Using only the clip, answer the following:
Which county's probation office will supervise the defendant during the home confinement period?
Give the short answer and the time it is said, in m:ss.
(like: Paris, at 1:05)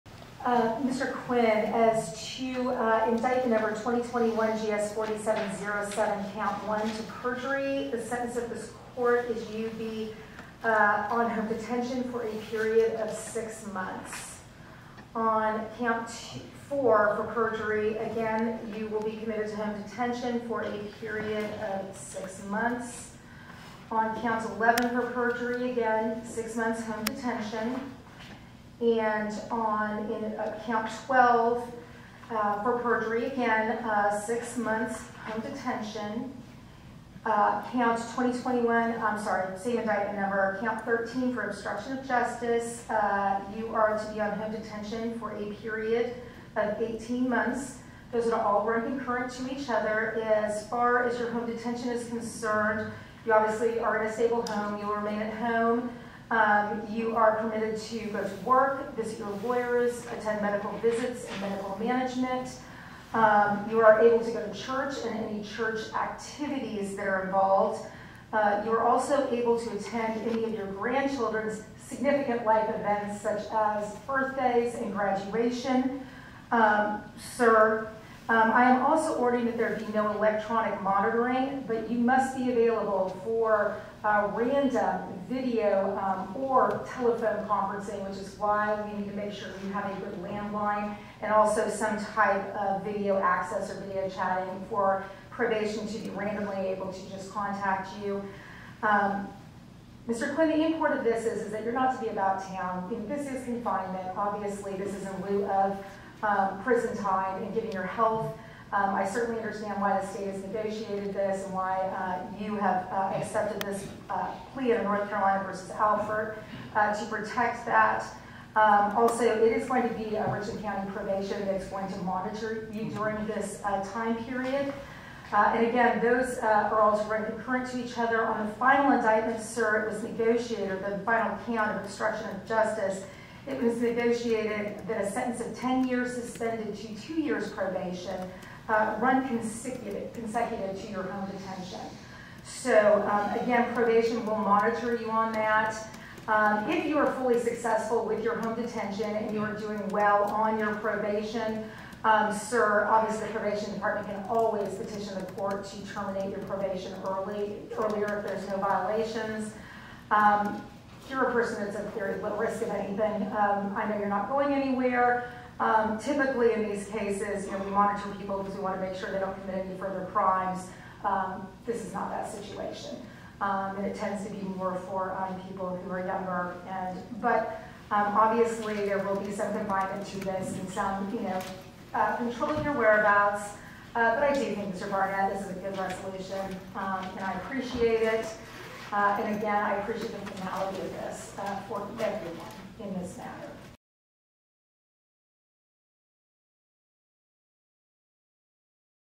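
Richland County, at 2:00.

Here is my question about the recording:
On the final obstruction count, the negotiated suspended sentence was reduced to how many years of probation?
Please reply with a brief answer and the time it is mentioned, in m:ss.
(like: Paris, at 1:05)
2 years, at 2:17.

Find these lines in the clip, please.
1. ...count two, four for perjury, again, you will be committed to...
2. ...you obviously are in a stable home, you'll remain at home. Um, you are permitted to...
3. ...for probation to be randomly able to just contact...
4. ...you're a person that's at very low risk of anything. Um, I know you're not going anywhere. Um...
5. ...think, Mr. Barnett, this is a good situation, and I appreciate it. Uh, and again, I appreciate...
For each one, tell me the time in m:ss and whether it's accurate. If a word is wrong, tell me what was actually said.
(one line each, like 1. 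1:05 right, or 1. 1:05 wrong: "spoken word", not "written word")
1. 0:15 right
2. 0:53 right
3. 1:34 right
4. 2:41 right
5. 3:04 wrong: "resolution", not "situation".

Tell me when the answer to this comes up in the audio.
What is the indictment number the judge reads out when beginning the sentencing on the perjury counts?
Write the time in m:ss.
0:03.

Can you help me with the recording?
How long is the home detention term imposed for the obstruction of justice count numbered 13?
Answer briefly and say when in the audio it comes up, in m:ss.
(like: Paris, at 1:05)
18 months, at 0:46.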